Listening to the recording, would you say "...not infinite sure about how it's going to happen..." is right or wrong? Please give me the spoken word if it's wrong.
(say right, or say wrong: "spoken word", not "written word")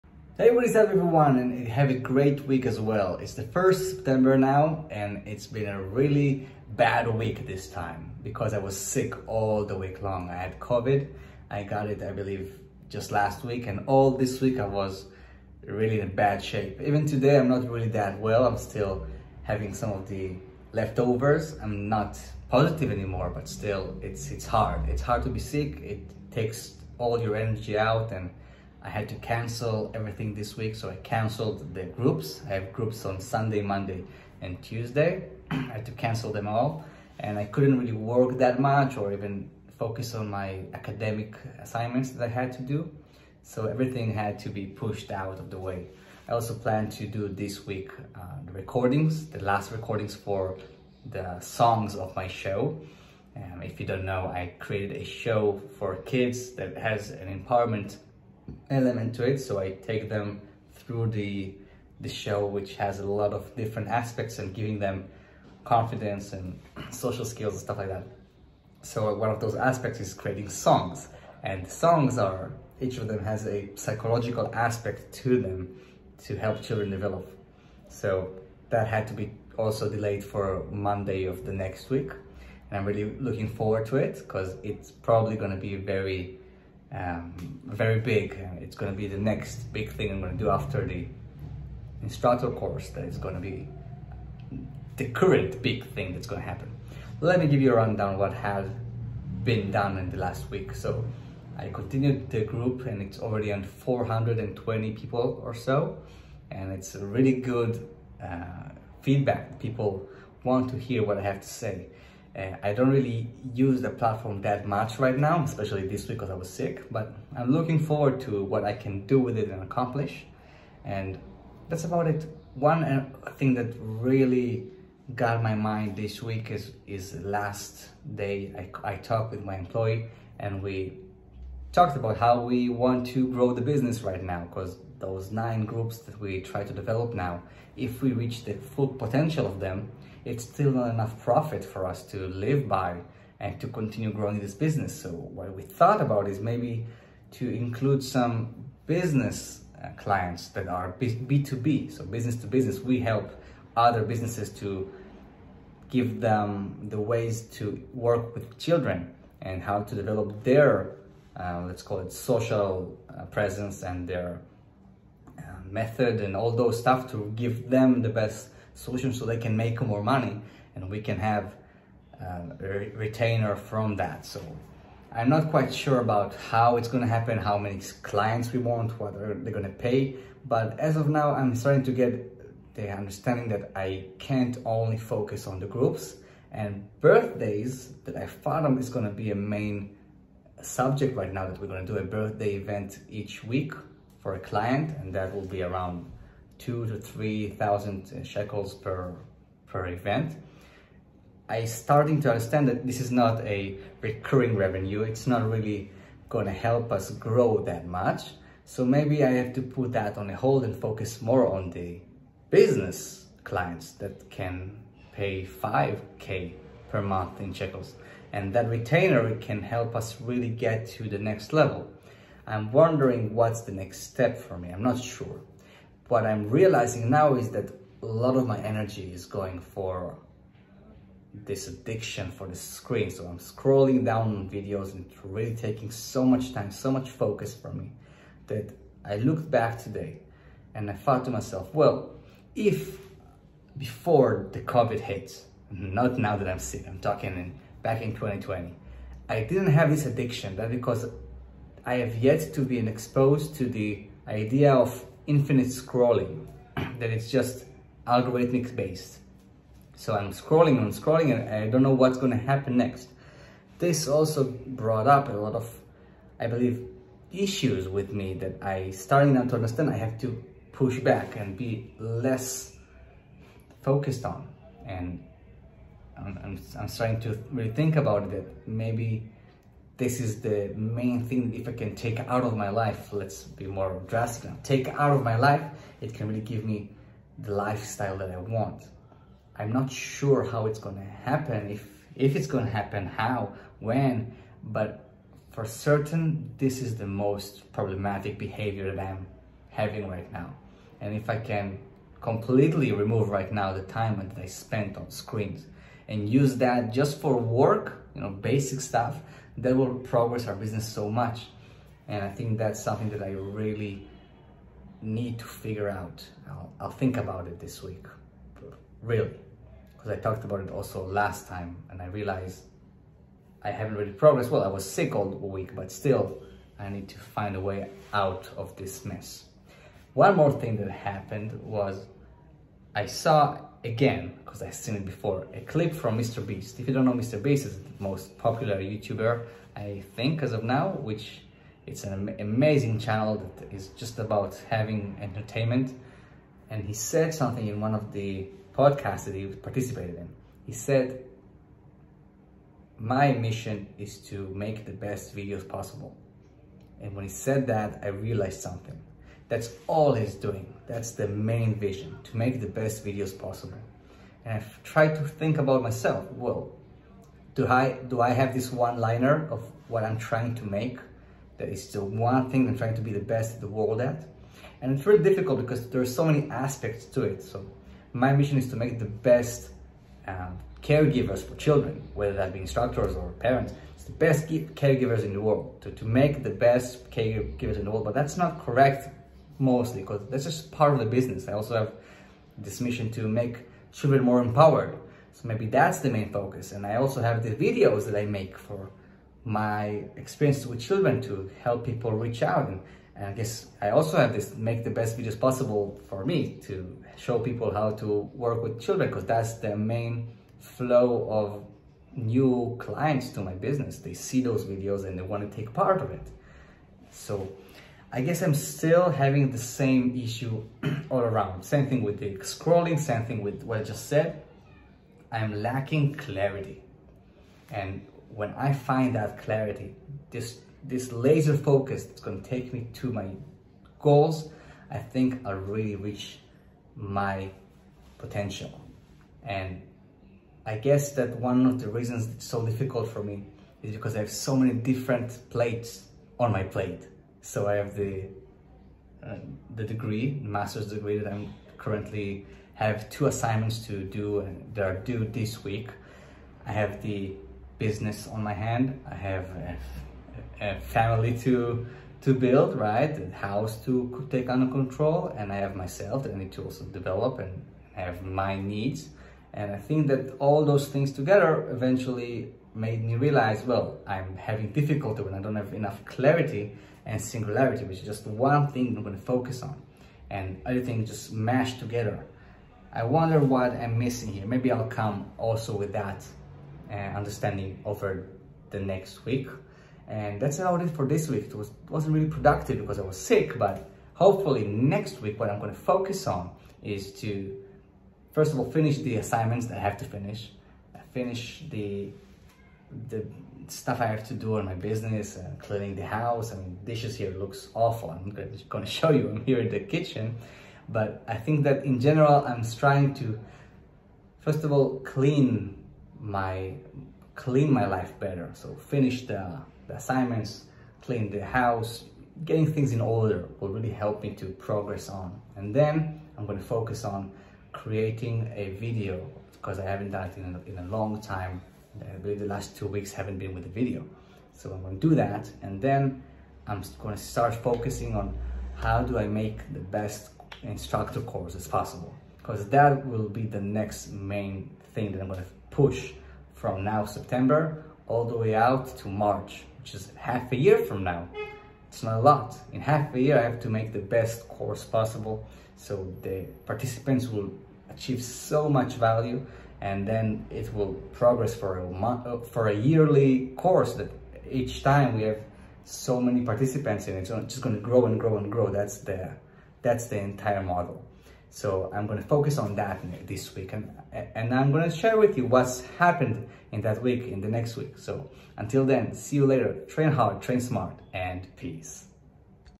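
wrong: "quite", not "infinite".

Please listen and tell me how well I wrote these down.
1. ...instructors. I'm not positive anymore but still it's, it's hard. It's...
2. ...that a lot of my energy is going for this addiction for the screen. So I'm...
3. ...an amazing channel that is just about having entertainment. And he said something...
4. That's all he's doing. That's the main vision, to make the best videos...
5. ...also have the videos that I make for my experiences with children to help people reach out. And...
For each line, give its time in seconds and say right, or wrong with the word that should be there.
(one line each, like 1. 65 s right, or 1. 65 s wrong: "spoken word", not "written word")
1. 20 s wrong: "leftovers", not "instructors"
2. 227 s right
3. 342 s right
4. 359 s right
5. 396 s right.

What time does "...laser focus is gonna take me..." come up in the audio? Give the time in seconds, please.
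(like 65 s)
431 s.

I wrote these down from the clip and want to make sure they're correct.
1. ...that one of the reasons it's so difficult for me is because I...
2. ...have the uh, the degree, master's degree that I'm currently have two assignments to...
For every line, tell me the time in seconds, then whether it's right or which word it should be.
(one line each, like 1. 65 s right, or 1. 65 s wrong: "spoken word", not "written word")
1. 441 s right
2. 447 s right.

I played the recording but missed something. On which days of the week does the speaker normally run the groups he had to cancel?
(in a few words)
Sunday, Monday, and Tuesday.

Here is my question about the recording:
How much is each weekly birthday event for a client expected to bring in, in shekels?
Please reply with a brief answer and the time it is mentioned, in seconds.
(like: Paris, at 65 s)
2,000 to 3,000 shekels, at 196 s.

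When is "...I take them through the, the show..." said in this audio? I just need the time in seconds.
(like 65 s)
59 s.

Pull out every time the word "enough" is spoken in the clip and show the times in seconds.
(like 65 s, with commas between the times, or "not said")
140 s, 475 s.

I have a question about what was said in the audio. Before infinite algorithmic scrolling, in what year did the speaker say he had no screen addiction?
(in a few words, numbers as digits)
2020.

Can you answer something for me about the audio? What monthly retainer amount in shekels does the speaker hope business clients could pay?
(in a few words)
5k.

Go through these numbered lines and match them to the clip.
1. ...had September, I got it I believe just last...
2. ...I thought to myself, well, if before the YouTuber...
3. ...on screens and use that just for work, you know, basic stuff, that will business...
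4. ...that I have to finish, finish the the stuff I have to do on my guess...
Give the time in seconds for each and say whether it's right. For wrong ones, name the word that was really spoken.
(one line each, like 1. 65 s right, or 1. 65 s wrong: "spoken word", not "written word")
1. 10 s wrong: "COVID", not "September"
2. 240 s wrong: "COVID", not "YouTuber"
3. 304 s wrong: "progress", not "business"
4. 499 s wrong: "business", not "guess".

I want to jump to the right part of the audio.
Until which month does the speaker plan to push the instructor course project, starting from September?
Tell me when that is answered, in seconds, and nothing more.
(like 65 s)
549 s.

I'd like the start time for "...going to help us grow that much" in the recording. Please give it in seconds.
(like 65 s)
206 s.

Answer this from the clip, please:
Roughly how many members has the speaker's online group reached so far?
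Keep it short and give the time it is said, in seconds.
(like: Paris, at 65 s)
420, at 103 s.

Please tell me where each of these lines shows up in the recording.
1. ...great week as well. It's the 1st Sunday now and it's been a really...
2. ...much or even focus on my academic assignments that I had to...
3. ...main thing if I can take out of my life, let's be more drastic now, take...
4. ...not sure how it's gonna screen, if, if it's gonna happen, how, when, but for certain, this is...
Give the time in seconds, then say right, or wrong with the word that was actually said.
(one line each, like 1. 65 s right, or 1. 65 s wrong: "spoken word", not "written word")
1. 1 s wrong: "September", not "Sunday"
2. 38 s right
3. 280 s right
4. 289 s wrong: "happen", not "screen".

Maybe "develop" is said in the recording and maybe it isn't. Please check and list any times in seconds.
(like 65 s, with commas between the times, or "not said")
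76 s, 136 s, 159 s, 466 s.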